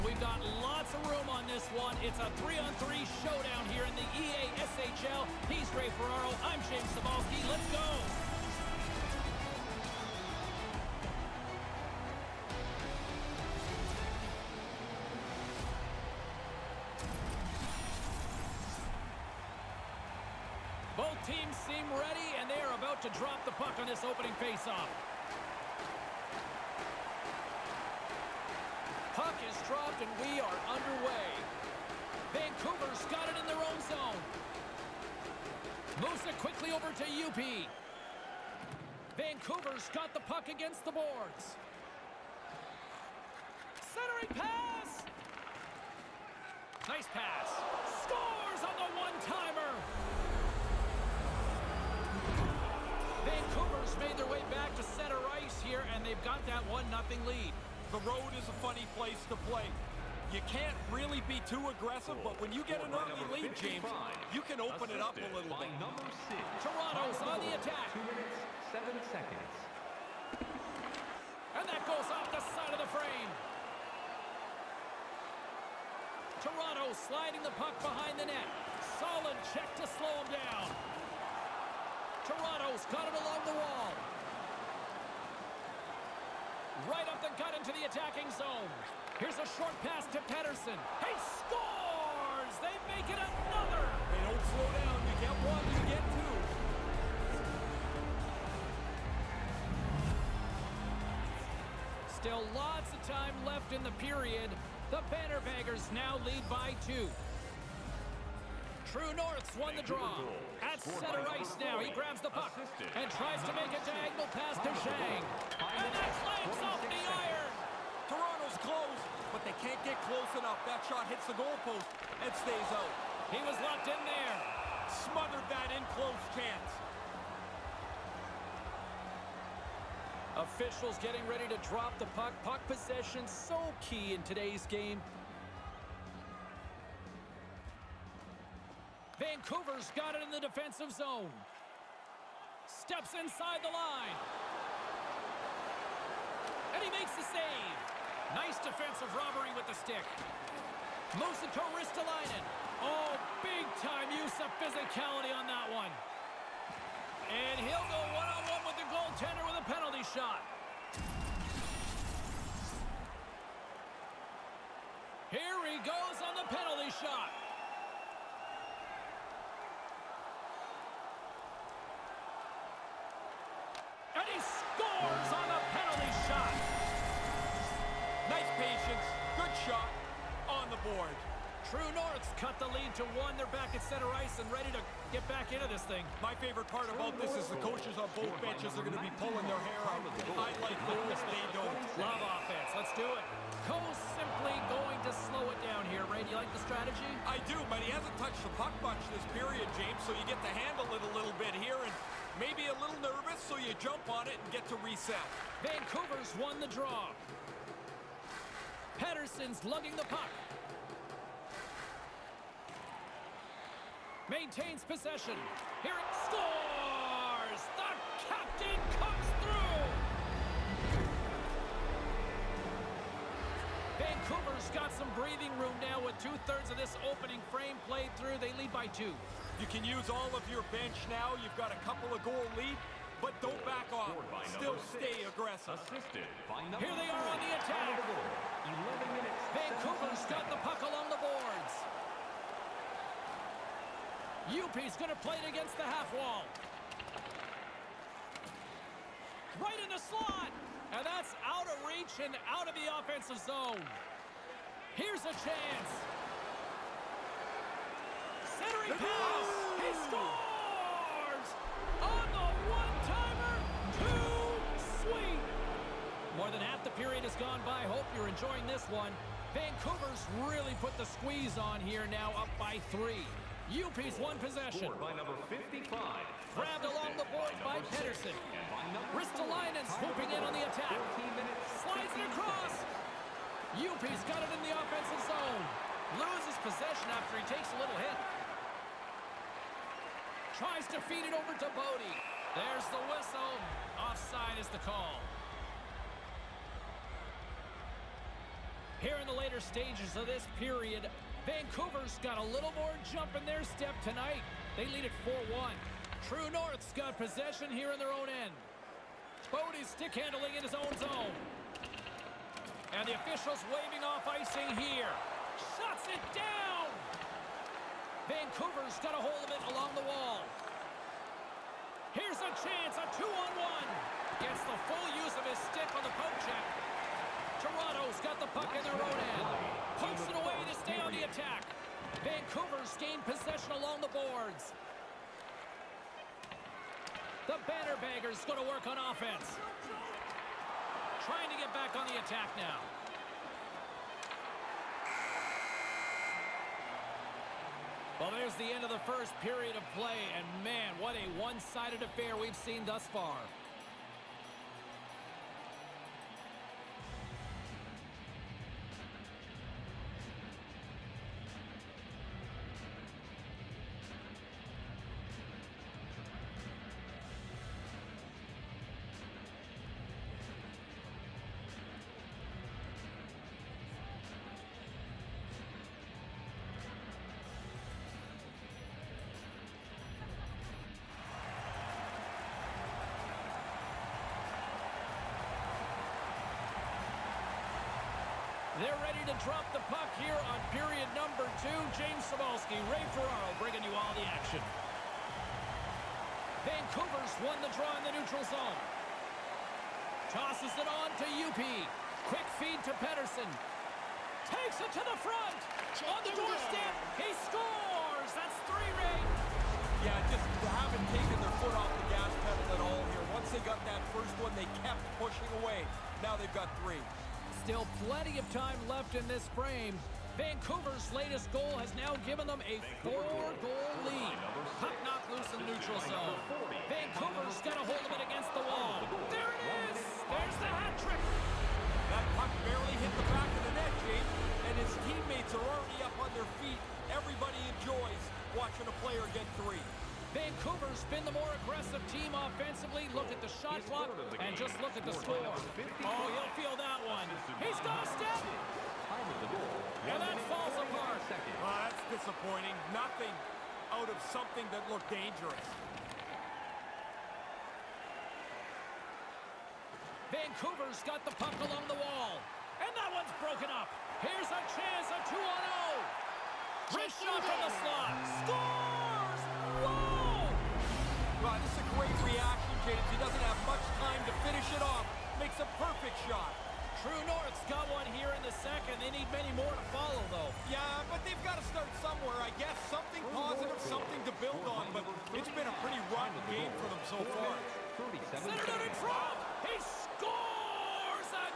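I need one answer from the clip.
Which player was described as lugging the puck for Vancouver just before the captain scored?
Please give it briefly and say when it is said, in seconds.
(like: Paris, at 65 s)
Patterson, at 209 s.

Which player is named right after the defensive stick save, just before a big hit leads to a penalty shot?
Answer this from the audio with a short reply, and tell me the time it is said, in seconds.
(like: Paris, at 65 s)
Musito Ristolainen, at 151 s.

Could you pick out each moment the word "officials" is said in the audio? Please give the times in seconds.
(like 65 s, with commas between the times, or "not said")
130 s, 313 s.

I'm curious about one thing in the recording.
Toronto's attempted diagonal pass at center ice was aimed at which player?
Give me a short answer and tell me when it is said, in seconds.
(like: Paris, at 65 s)
Shang, at 114 s.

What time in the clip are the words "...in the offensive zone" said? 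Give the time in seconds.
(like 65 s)
284 s.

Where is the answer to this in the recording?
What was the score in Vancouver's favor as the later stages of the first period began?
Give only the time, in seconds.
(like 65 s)
305 s.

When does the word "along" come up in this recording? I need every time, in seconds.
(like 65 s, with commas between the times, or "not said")
83 s, 240 s, 276 s, 319 s, 333 s, 461 s.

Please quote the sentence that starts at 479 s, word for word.
They need many more to follow, though.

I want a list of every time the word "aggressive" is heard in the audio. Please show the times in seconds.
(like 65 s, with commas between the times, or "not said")
61 s, 235 s, 441 s.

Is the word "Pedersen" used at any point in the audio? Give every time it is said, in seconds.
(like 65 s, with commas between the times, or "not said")
90 s, 277 s, 403 s.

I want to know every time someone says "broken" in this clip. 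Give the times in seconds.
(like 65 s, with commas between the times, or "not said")
463 s.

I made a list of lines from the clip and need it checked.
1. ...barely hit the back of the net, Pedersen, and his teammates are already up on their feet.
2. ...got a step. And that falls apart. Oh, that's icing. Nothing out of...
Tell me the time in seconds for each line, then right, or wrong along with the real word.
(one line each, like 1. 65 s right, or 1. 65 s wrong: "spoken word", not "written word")
1. 432 s wrong: "James", not "Pedersen"
2. 447 s wrong: "disappointing", not "icing".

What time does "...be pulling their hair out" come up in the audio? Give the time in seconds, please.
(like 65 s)
189 s.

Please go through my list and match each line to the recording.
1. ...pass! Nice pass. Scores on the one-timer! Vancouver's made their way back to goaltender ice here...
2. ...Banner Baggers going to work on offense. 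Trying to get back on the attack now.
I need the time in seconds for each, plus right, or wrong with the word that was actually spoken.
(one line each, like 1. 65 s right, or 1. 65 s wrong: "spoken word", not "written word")
1. 44 s wrong: "center", not "goaltender"
2. 337 s right.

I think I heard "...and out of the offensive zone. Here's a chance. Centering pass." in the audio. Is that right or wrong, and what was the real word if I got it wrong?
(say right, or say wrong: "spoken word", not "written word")
right.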